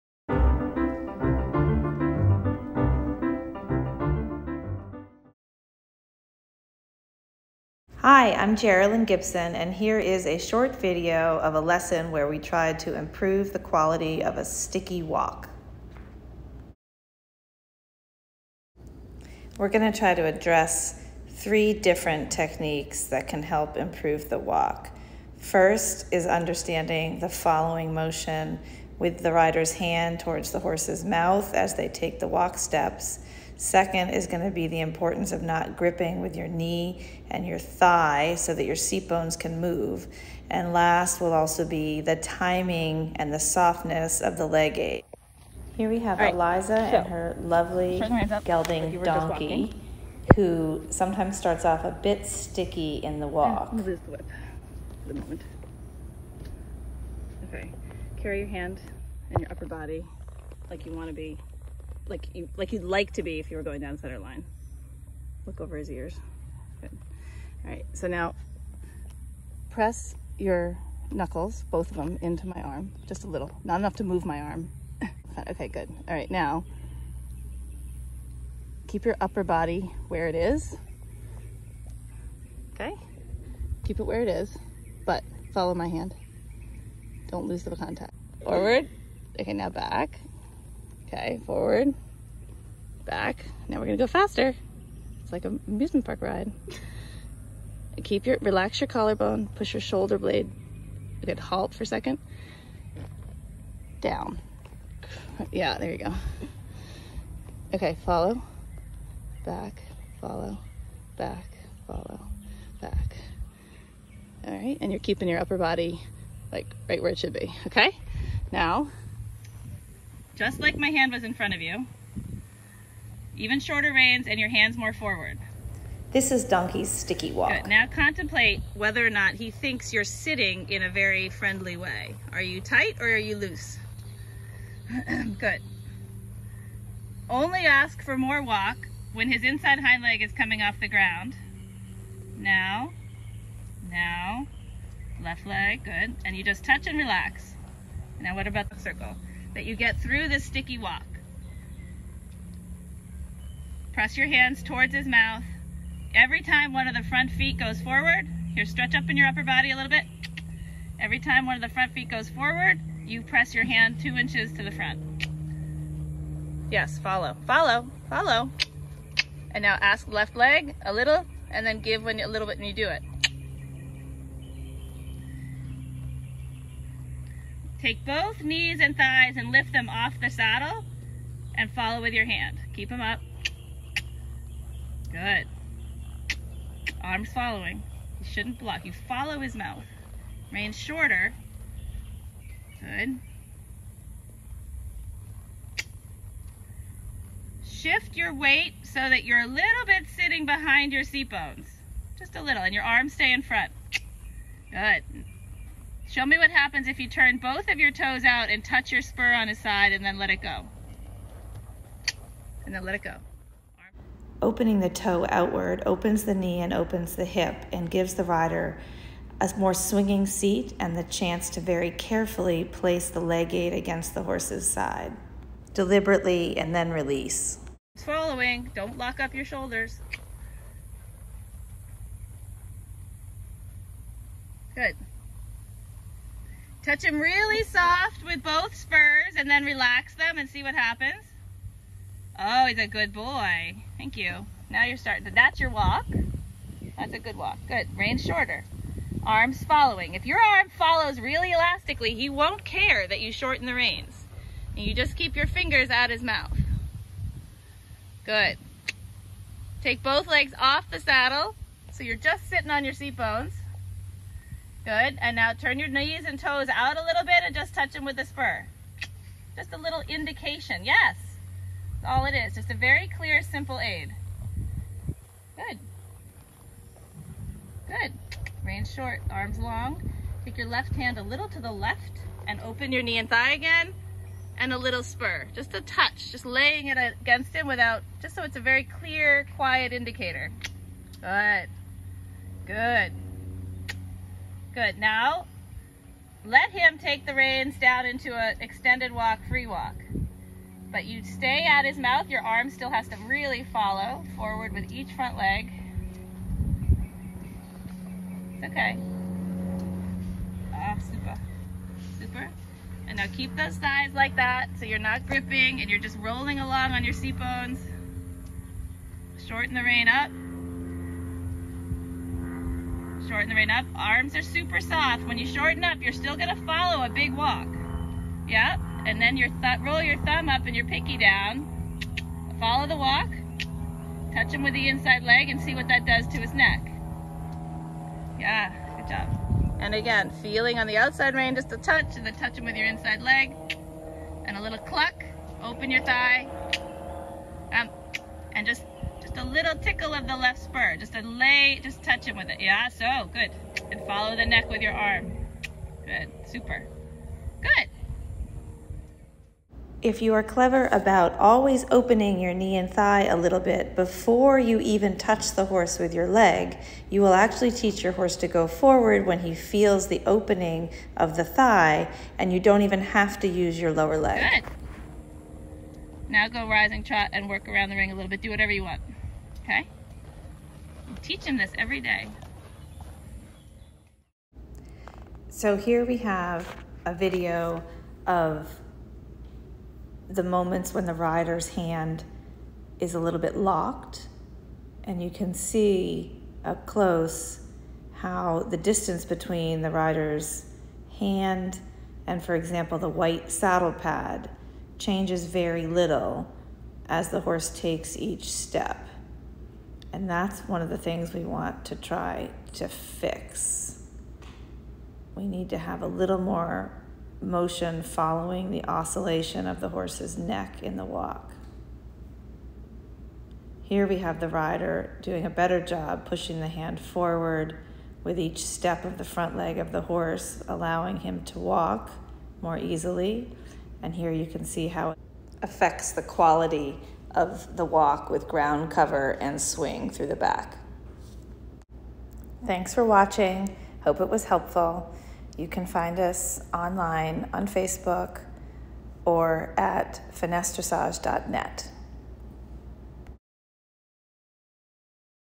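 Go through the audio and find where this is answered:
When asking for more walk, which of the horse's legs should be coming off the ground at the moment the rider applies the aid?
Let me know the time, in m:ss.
2:19.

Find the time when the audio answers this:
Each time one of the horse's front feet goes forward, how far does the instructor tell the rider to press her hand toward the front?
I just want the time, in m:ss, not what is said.
2:44.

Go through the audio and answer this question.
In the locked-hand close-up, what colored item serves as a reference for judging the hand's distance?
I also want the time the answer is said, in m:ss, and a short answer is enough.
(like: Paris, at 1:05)
white saddle pad, at 6:43.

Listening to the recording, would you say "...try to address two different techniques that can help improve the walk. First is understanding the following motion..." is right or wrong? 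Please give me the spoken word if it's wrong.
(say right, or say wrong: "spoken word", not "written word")
wrong: "three", not "two".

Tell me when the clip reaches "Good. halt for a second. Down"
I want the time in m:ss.
1:41.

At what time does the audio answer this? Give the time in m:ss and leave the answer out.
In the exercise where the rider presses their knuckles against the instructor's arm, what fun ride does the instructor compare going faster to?
1:35.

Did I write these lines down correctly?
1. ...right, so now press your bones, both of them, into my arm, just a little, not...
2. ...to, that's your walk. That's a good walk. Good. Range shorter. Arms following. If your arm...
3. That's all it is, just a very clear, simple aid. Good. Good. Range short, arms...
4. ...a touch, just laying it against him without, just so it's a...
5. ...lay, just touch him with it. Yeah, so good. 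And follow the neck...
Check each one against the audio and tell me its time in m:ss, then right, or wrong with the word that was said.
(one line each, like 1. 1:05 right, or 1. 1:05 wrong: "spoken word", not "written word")
1. 1:07 wrong: "knuckles", not "bones"
2. 4:05 right
3. 4:32 right
4. 4:45 right
5. 5:51 right.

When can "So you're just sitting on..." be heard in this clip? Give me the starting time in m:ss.
4:21.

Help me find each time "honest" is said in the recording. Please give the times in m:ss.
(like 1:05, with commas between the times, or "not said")
not said.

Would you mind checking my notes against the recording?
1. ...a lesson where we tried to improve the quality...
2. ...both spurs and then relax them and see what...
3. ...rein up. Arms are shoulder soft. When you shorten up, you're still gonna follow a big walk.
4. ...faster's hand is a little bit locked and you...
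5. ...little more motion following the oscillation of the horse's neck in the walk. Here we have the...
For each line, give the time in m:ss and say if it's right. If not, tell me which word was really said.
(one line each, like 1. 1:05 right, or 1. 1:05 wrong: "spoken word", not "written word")
1. 0:11 right
2. 3:58 right
3. 5:23 wrong: "super", not "shoulder"
4. 6:31 wrong: "rider", not "faster"
5. 6:56 right.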